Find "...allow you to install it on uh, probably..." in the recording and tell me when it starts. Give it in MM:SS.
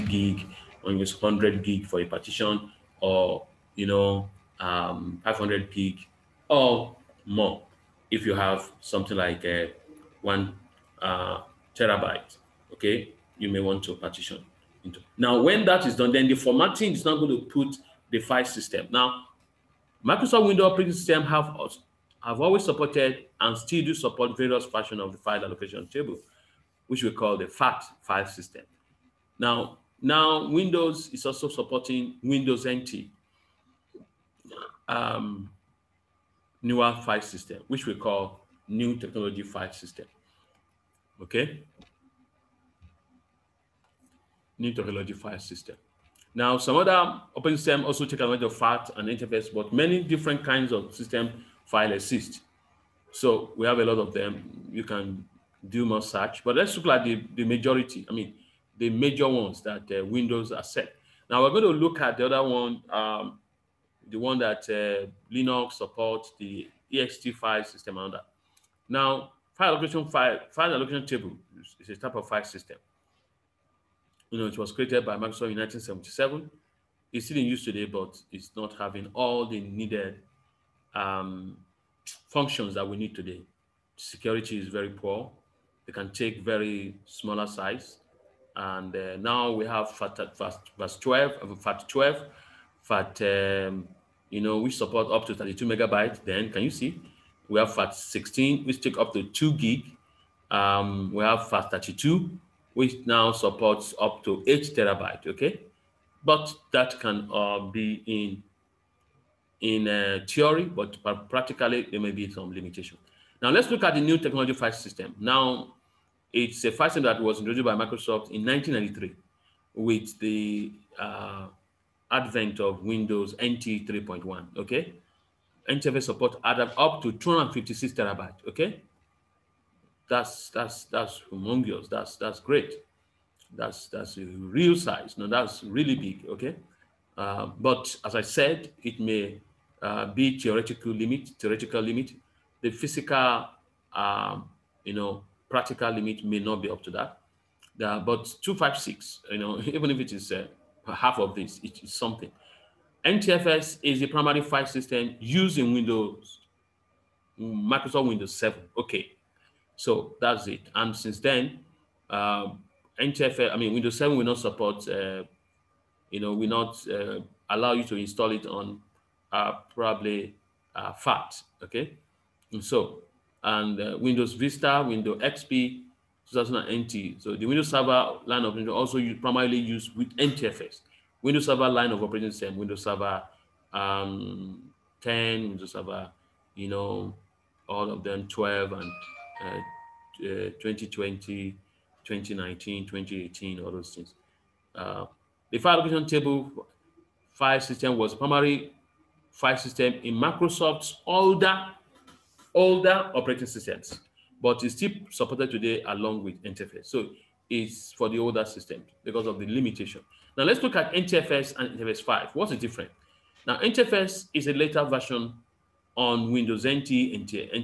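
02:47.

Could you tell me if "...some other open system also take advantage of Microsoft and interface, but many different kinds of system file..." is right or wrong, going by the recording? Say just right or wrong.
wrong.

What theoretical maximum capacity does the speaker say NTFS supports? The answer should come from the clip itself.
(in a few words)
256 terabytes.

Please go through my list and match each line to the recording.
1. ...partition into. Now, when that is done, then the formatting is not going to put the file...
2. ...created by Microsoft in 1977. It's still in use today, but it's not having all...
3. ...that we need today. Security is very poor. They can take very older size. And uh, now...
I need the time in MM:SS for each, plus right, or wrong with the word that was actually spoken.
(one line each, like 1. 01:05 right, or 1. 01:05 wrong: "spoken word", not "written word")
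1. 00:13 right
2. 01:14 right
3. 01:22 wrong: "smaller", not "older".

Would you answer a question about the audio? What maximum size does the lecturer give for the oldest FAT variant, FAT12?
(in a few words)
32 megabytes.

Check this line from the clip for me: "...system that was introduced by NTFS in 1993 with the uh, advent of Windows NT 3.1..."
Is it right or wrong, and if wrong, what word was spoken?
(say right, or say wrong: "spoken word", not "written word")
wrong: "Microsoft", not "NTFS".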